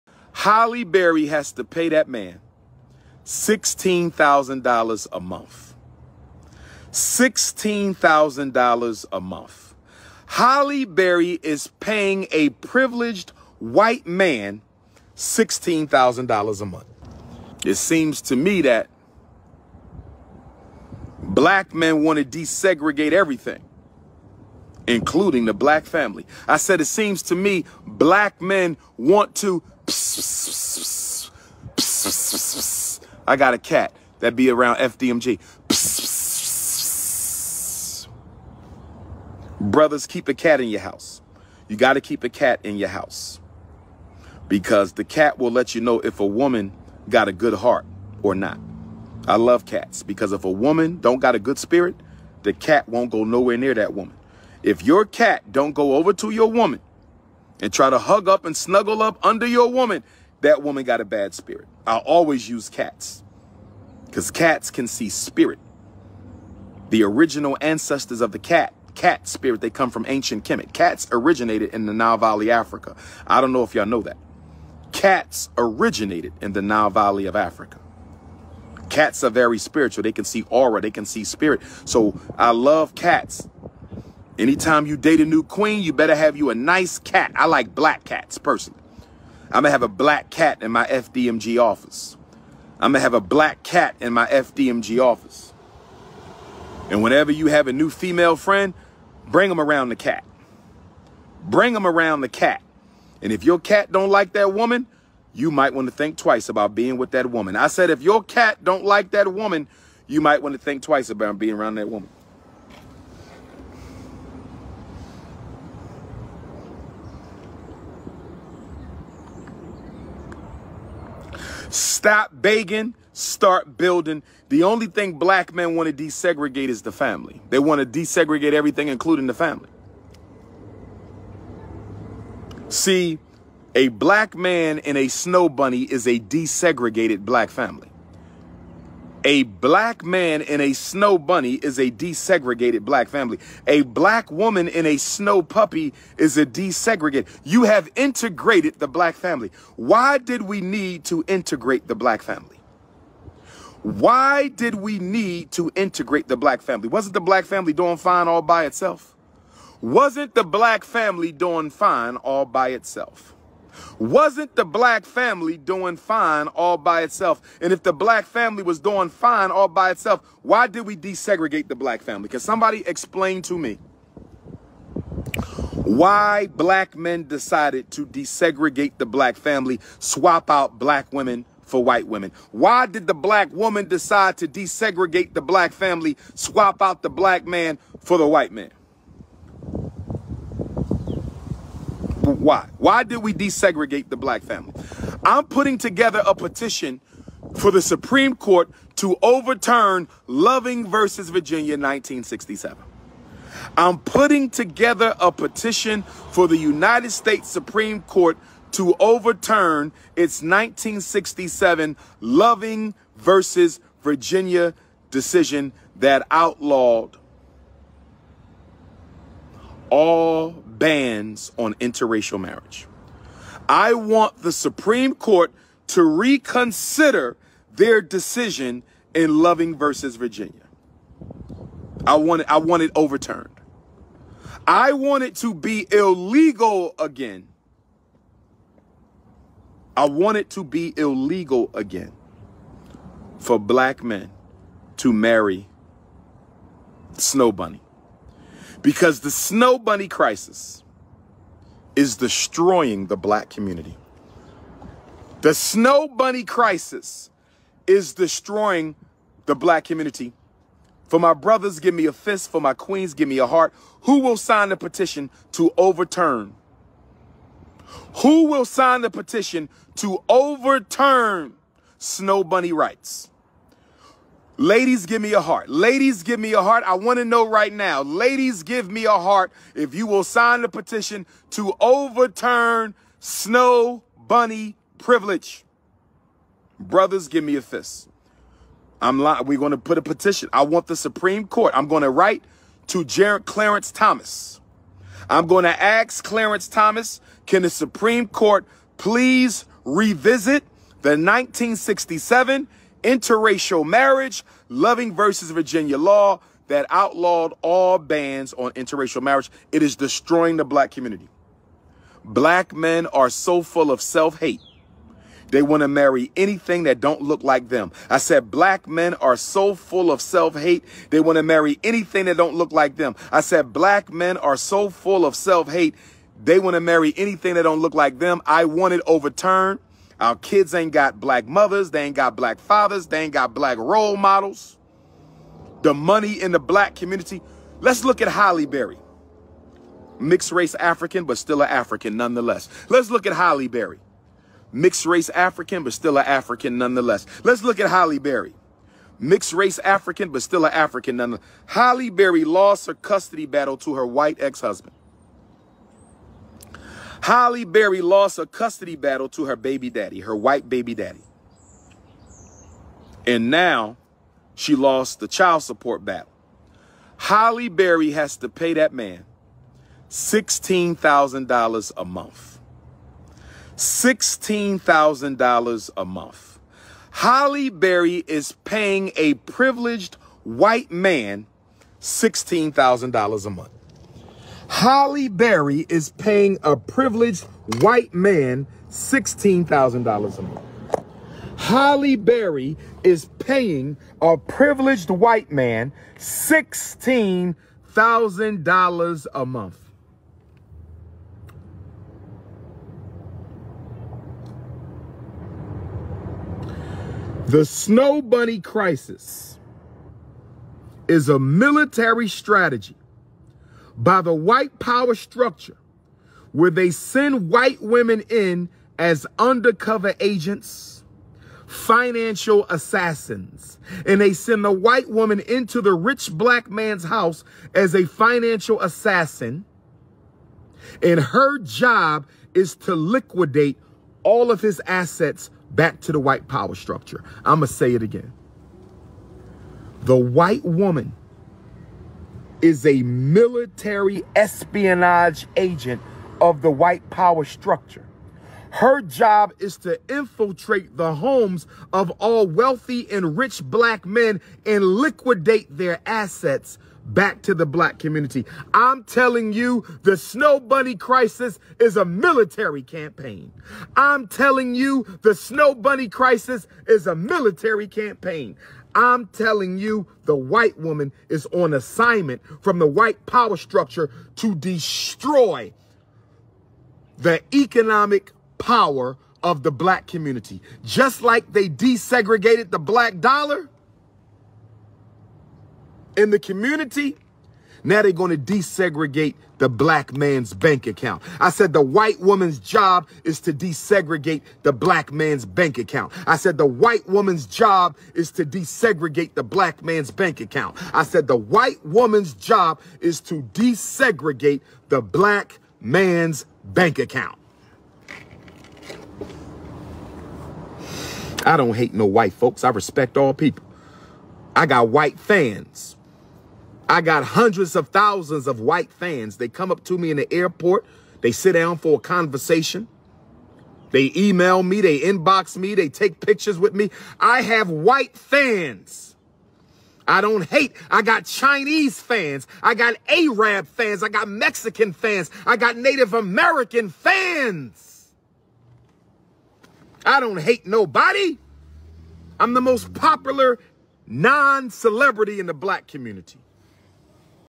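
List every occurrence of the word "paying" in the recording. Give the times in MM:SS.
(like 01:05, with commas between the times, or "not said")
00:11, 06:18, 06:26, 06:33.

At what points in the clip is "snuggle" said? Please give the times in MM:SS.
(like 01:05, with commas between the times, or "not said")
00:58.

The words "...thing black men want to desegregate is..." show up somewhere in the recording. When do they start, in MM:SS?
02:04.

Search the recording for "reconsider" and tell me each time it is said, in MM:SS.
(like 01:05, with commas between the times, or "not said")
03:46.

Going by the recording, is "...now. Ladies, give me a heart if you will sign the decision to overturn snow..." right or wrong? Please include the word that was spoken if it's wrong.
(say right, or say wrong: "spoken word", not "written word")
wrong: "petition", not "decision".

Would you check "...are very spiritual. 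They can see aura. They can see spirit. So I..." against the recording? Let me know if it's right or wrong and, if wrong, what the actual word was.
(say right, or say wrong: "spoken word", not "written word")
right.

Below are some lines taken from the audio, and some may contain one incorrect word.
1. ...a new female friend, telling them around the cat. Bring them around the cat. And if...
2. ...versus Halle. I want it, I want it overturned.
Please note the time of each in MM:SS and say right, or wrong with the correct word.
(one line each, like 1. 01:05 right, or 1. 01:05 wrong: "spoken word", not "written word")
1. 01:37 wrong: "bring", not "telling"
2. 03:49 wrong: "Virginia", not "Halle".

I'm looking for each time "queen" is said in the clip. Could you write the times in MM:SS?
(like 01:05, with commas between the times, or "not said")
01:25, 04:22.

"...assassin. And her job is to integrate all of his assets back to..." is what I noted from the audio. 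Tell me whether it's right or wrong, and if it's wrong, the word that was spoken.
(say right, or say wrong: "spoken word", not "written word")
wrong: "liquidate", not "integrate".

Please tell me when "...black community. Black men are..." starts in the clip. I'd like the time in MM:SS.
05:10.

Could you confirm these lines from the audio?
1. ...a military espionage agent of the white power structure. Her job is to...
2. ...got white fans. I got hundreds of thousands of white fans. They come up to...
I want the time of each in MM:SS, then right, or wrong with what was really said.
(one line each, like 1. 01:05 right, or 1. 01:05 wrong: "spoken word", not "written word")
1. 07:22 right
2. 08:34 right.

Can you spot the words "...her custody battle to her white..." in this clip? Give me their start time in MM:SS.
05:52.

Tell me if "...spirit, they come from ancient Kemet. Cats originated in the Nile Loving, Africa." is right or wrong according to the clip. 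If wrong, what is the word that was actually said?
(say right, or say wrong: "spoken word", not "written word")
wrong: "Valley", not "Loving".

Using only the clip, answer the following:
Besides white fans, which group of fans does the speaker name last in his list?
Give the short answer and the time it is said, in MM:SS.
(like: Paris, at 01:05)
Native American, at 08:55.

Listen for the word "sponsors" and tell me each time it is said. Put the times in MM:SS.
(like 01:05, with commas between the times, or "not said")
not said.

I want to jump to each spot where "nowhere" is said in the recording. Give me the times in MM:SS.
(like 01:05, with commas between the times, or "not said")
00:53.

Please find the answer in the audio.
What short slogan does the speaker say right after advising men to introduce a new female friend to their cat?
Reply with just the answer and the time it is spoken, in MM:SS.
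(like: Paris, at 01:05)
Stop begging, start building, at 02:01.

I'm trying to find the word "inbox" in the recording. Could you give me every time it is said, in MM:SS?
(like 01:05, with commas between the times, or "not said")
08:44.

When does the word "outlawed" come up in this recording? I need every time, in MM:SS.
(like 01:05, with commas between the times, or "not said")
03:36, 05:06.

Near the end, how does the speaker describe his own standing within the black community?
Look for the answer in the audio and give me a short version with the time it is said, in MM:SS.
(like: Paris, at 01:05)
most popular non-celebrity, at 09:02.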